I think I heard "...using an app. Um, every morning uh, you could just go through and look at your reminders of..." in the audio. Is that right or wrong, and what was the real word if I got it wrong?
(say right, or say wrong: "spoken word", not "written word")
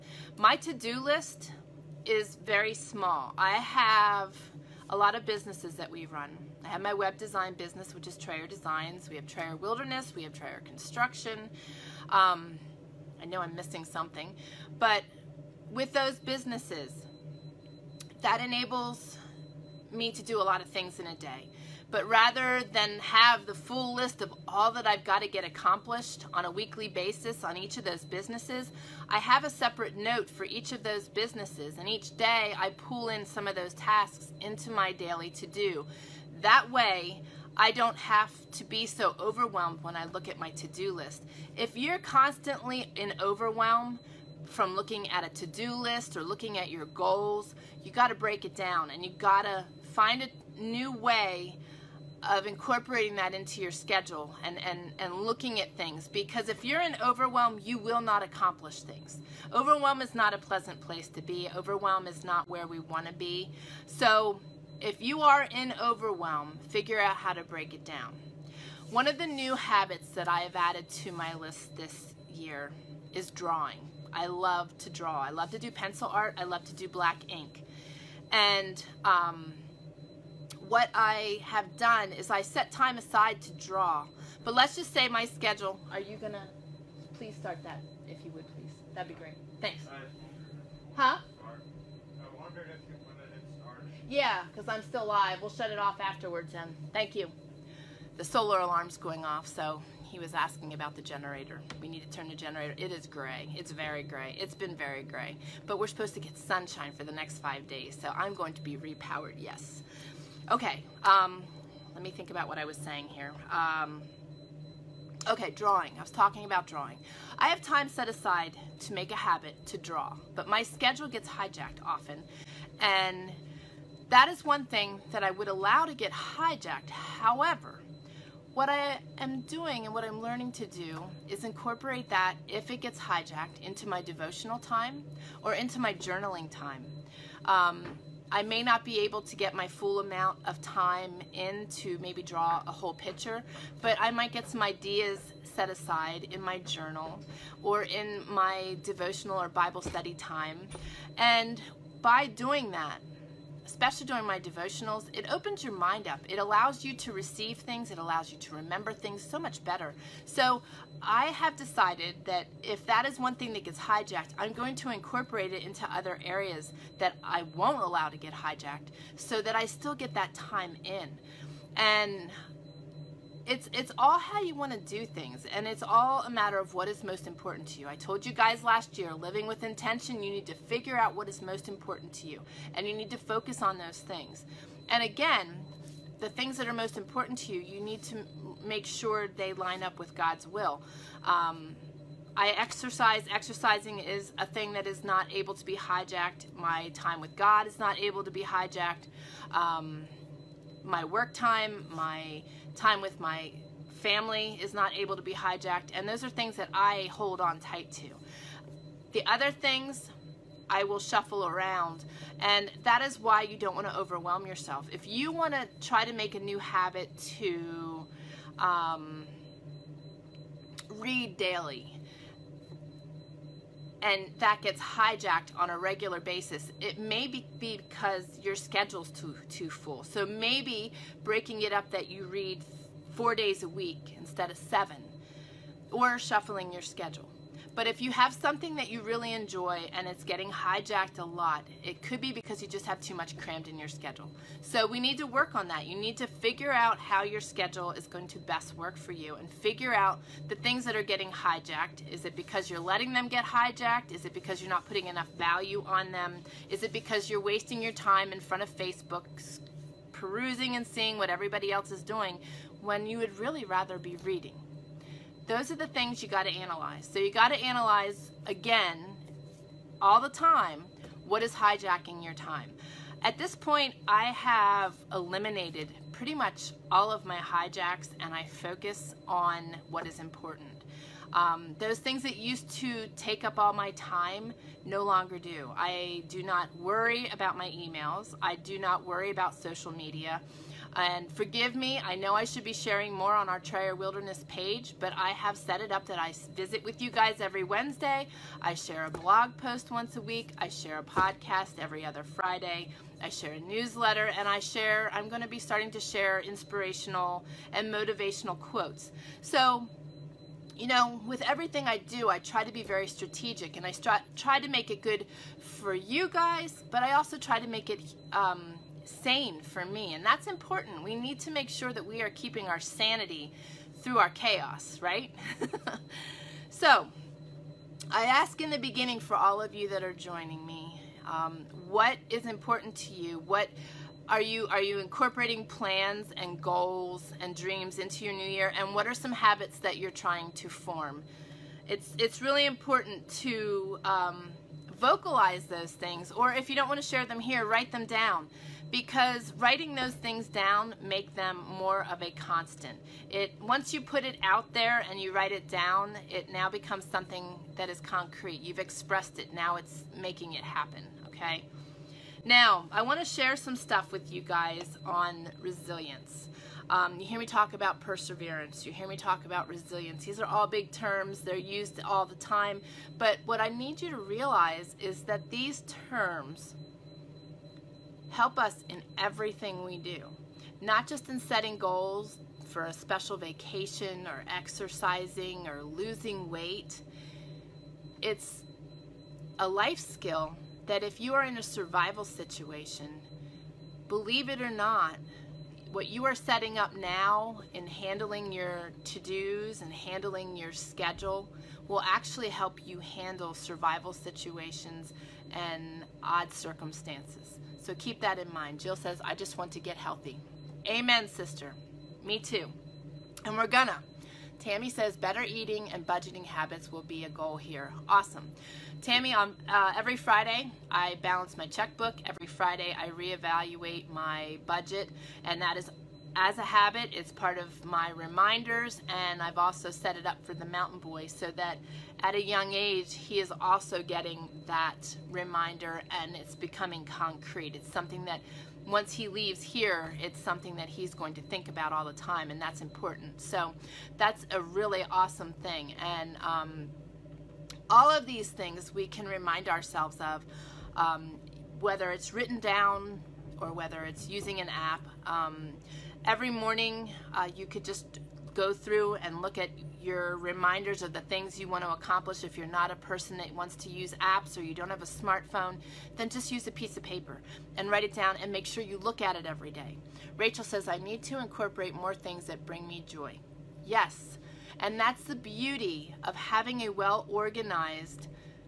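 right.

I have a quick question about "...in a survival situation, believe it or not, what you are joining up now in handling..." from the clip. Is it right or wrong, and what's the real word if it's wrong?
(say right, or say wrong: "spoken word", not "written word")
wrong: "setting", not "joining".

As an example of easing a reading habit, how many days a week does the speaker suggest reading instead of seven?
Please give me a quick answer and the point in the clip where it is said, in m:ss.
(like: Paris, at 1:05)
4, at 3:53.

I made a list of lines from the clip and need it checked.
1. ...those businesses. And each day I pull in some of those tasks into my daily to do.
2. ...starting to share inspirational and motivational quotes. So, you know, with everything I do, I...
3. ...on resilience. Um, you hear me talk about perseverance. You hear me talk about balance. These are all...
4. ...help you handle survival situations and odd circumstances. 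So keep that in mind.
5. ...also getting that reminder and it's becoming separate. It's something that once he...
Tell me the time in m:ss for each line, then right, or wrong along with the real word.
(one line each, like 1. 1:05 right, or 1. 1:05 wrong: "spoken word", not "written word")
1. 0:30 right
2. 5:05 right
3. 6:05 wrong: "resilience", not "balance"
4. 6:42 right
5. 7:13 wrong: "concrete", not "separate".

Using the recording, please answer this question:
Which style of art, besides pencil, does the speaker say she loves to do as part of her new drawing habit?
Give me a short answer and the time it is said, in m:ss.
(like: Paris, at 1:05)
Black ink, at 1:16.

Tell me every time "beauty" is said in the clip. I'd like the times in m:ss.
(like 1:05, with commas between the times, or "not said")
7:55.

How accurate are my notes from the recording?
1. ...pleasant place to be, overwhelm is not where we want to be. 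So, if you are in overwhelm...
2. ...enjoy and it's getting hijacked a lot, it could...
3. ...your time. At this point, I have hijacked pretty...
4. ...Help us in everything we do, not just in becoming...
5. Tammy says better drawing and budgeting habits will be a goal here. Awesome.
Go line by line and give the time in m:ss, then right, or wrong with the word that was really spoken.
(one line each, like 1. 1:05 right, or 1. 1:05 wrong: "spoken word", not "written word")
1. 1:00 right
2. 3:59 right
3. 4:32 wrong: "eliminated", not "hijacked"
4. 6:18 wrong: "setting", not "becoming"
5. 6:54 wrong: "eating", not "drawing".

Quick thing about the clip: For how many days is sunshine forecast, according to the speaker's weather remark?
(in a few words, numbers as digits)
5.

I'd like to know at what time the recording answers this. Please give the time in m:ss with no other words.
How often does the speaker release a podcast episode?
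5:01.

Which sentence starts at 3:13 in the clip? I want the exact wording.
Exercising is a thing that is not able to be hijacked.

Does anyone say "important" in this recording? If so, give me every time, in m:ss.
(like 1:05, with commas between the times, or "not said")
2:57, 3:01, 3:06, 4:40, 5:20, 5:32, 5:42, 7:22.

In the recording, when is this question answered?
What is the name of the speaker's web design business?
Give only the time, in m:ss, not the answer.
0:08.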